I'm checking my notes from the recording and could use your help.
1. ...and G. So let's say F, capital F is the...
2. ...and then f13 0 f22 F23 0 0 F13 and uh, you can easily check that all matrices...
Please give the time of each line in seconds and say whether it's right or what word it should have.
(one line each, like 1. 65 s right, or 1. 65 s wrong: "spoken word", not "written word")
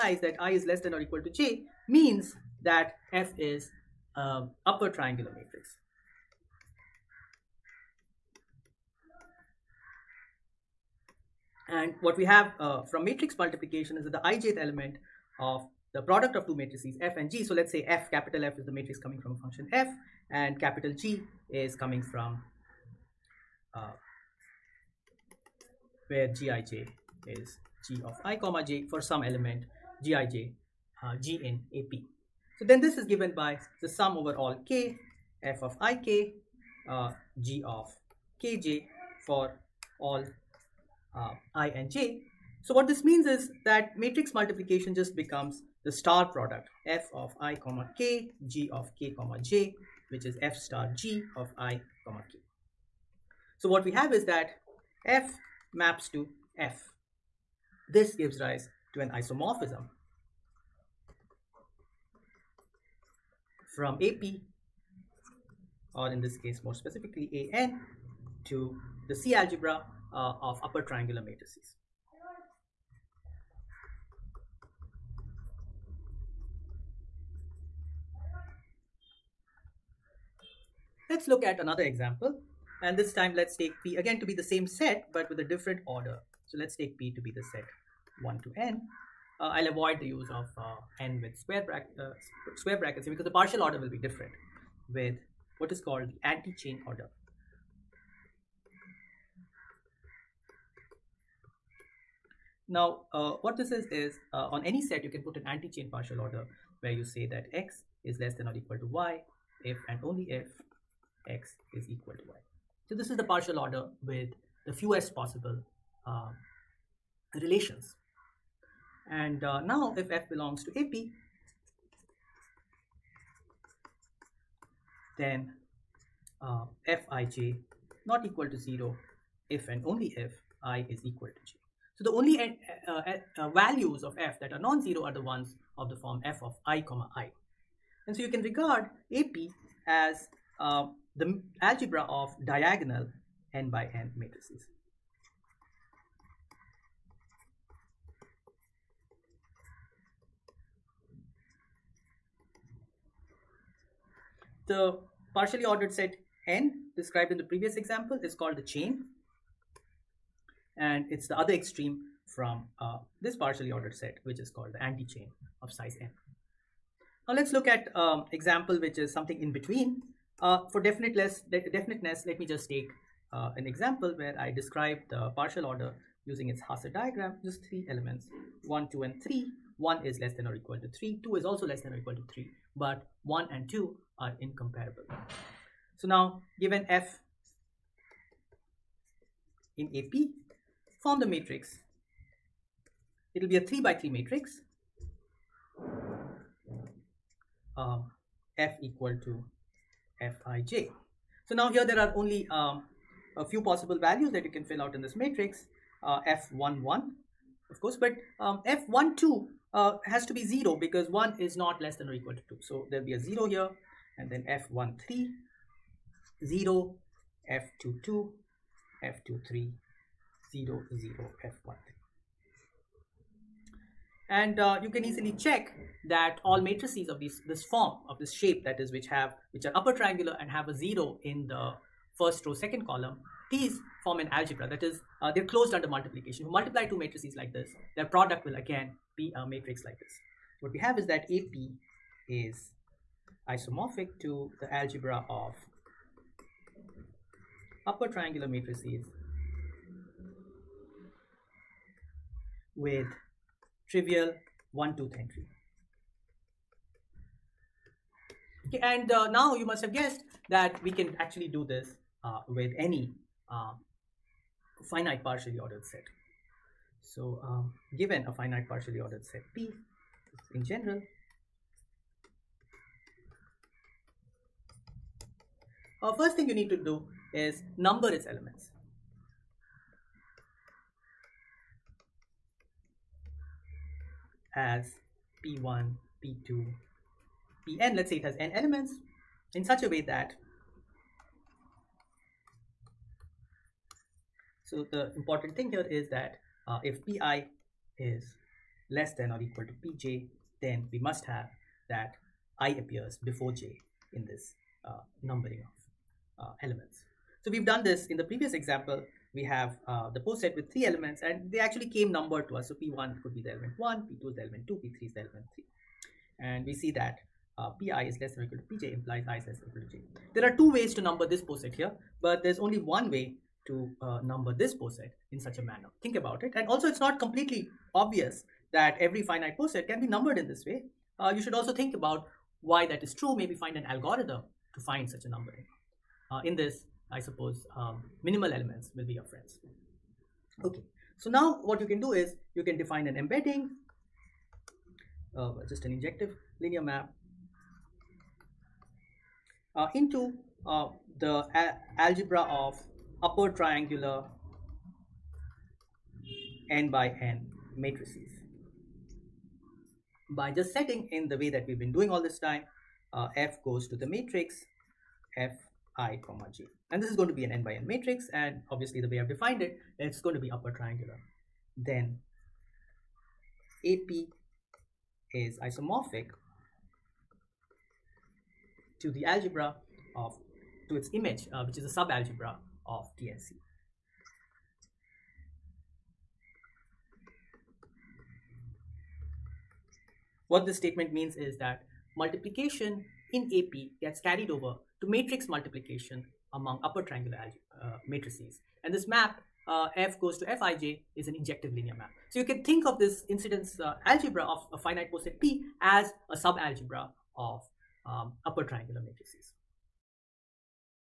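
1. 17 s right
2. 214 s right.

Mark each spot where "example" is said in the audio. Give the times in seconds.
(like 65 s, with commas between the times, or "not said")
81 s, 157 s, 168 s, 173 s, 308 s.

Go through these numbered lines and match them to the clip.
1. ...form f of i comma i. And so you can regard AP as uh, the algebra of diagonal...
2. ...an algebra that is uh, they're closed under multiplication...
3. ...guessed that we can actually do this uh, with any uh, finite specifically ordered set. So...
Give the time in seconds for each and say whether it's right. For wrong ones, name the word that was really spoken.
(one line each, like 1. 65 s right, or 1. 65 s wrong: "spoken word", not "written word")
1. 135 s right
2. 234 s right
3. 259 s wrong: "partially", not "specifically".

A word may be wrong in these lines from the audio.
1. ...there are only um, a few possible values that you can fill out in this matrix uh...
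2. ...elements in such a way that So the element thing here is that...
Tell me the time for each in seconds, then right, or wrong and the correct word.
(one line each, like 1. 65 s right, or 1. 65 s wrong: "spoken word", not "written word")
1. 201 s right
2. 288 s wrong: "important", not "element".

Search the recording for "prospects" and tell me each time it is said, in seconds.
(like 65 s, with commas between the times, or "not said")
not said.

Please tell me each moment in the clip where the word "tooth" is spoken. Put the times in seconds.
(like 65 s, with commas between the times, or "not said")
254 s.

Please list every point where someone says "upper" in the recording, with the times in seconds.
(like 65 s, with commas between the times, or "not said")
70 s, 229 s, 247 s, 353 s, 370 s, 396 s, 408 s.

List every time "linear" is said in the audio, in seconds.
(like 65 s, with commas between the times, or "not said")
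346 s, 401 s.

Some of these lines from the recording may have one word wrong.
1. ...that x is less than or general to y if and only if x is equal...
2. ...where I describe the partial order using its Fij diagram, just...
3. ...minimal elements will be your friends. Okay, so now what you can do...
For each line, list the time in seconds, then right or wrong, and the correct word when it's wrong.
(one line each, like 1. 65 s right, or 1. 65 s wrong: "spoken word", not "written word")
1. 107 s wrong: "equal", not "general"
2. 174 s wrong: "Hasse", not "Fij"
3. 338 s right.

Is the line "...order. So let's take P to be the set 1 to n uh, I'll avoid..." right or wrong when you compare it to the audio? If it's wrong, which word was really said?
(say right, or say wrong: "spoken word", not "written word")
right.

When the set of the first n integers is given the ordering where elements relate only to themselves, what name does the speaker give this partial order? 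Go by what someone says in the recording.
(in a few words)
anti-chain order.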